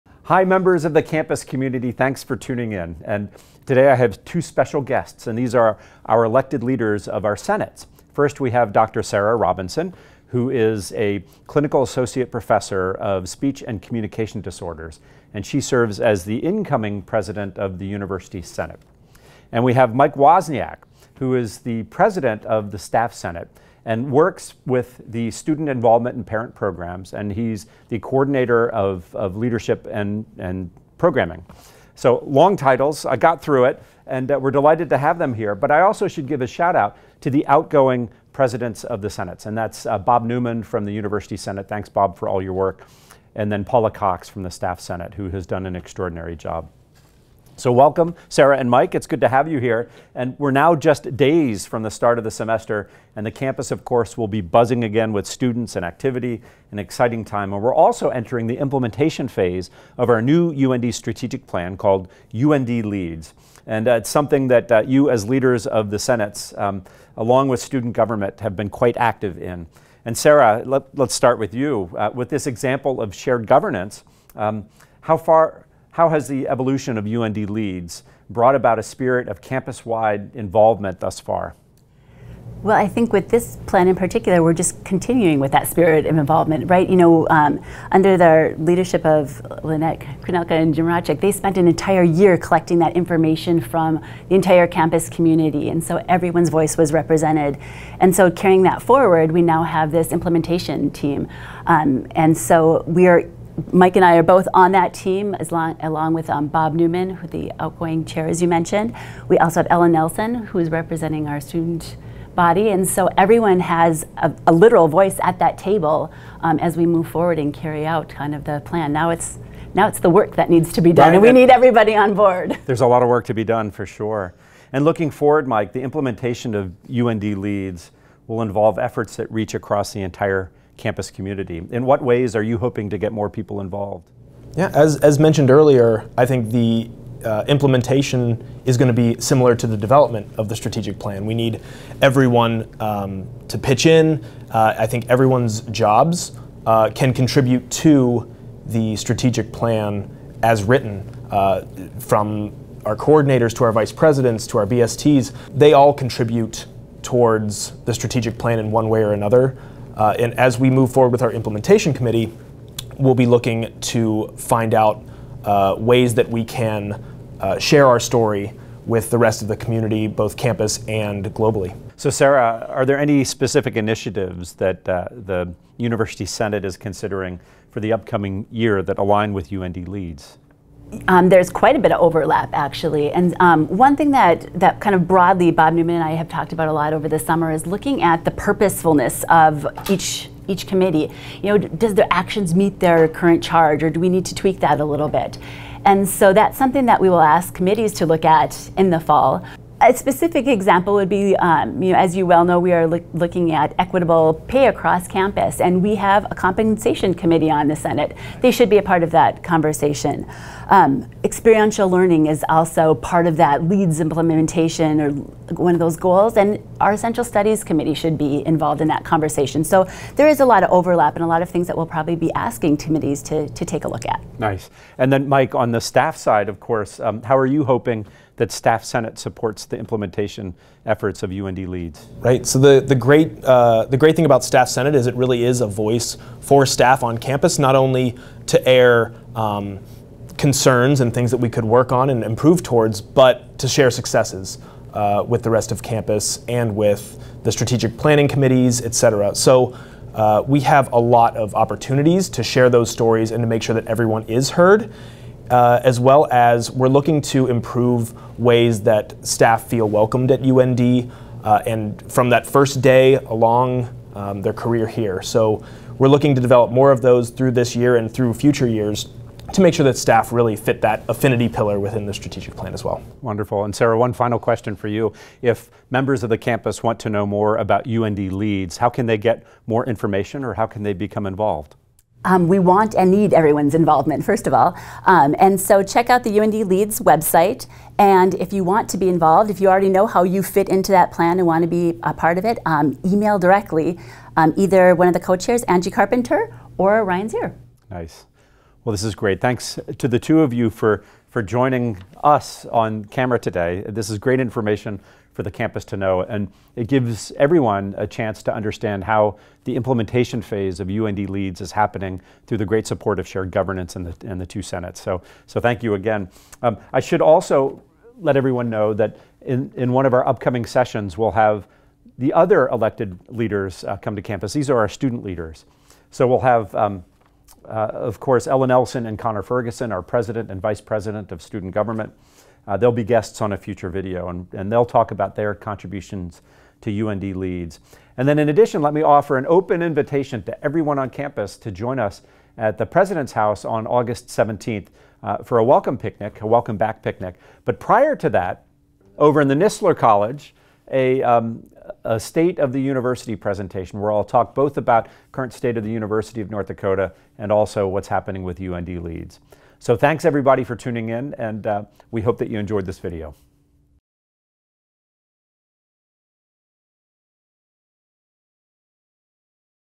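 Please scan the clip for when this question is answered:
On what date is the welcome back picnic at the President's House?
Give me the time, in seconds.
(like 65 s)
343 s.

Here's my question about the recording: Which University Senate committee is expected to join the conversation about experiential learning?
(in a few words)
Essential Studies Committee.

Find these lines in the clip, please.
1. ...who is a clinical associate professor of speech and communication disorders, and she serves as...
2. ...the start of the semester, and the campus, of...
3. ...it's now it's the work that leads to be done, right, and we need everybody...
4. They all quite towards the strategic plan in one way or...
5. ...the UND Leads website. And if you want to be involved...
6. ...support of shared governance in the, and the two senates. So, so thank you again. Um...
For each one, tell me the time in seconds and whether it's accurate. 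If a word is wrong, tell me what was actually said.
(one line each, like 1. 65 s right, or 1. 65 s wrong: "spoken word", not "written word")
1. 10 s right
2. 51 s right
3. 119 s wrong: "needs", not "leads"
4. 155 s wrong: "contribute", not "quite"
5. 286 s right
6. 312 s right.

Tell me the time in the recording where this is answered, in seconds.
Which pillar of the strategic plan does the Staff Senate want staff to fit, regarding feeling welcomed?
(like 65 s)
271 s.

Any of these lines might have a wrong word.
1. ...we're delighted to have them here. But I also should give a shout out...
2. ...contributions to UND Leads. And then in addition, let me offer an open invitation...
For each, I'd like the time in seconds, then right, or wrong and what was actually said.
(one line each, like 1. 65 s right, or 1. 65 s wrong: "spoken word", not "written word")
1. 34 s right
2. 335 s right.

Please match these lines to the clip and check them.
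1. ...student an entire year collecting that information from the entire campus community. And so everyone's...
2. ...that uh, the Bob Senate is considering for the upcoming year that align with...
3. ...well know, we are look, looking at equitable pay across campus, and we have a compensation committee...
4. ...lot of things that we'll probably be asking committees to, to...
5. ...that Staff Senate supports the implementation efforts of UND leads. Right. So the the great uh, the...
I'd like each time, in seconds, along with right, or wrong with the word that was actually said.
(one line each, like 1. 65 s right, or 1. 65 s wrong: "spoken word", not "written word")
1. 91 s wrong: "spent", not "student"
2. 174 s wrong: "University", not "Bob"
3. 202 s right
4. 221 s right
5. 228 s right.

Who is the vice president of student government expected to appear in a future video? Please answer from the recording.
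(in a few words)
Connor Ferguson.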